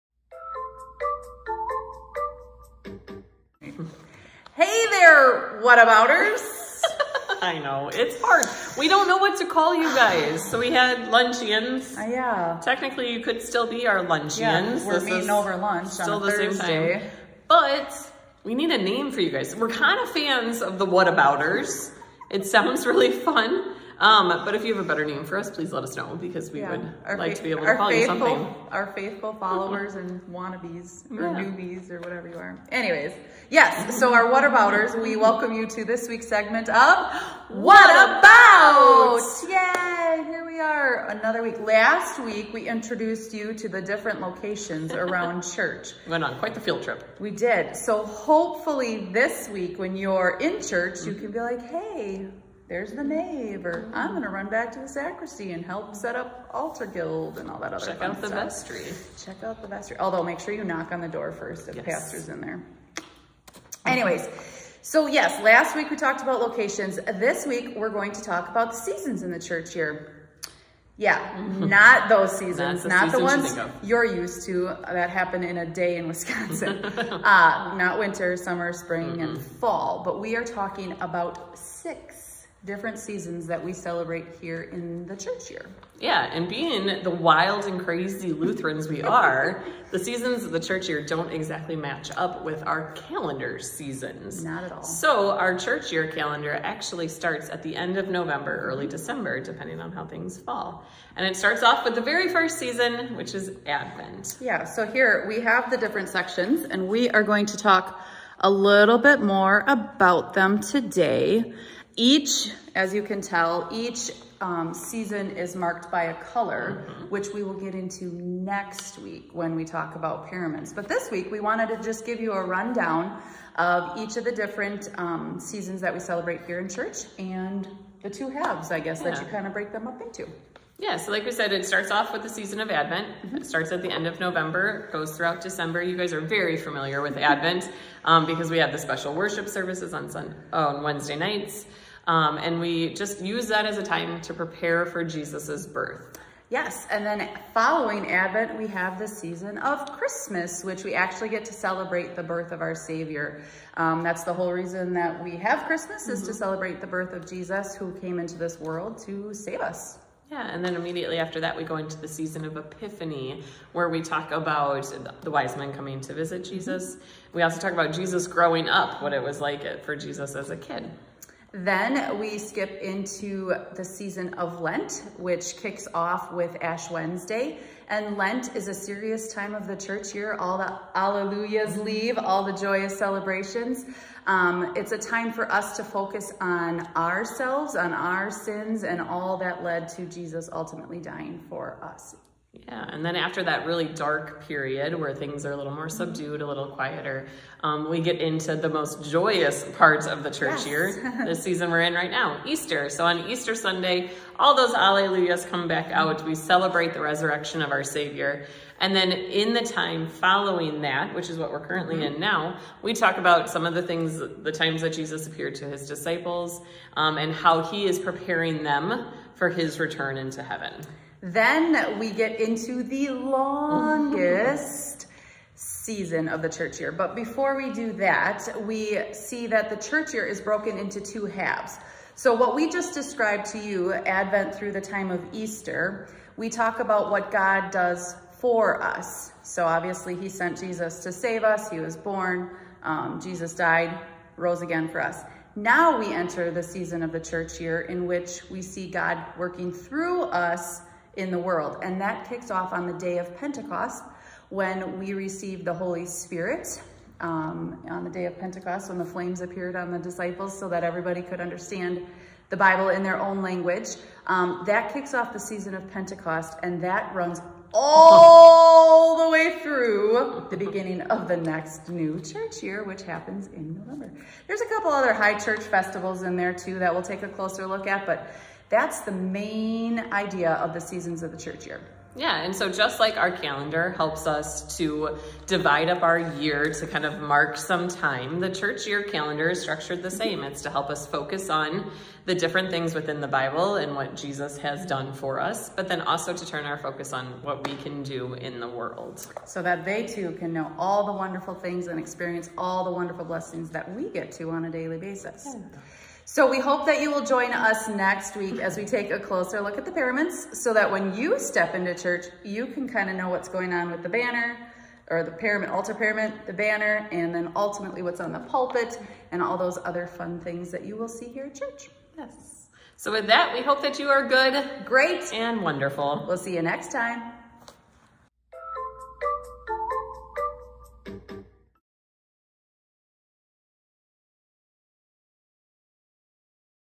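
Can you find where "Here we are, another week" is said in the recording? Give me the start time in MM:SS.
00:40.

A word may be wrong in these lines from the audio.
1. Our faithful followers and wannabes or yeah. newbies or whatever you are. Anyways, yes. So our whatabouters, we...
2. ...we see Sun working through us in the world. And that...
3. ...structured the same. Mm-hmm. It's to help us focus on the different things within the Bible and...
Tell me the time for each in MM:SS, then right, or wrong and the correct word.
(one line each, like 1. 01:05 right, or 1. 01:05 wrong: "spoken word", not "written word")
1. 00:28 right
2. 04:08 wrong: "God", not "Sun"
3. 04:49 right.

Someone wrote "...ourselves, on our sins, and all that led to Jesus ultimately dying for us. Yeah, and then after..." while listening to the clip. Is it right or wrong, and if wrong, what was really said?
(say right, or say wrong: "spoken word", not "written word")
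right.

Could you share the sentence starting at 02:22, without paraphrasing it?
Um, and we just use that as a time to prepare for Jesus's birth.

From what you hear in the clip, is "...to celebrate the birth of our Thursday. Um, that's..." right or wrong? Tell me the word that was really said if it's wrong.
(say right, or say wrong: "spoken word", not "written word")
wrong: "Savior", not "Thursday".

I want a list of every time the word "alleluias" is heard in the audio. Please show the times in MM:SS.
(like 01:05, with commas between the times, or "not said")
03:00, 03:24.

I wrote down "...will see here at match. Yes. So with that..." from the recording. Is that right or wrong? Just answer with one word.
wrong.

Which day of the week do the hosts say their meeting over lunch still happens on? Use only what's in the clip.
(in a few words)
Thursday.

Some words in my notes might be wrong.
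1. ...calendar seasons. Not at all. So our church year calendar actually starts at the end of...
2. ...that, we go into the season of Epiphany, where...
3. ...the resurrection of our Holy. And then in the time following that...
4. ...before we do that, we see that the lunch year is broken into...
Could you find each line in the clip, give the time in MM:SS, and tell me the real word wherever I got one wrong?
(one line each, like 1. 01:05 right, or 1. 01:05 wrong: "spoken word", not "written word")
1. 01:32 right
2. 02:41 right
3. 03:26 wrong: "Savior", not "Holy"
4. 03:47 wrong: "church", not "lunch".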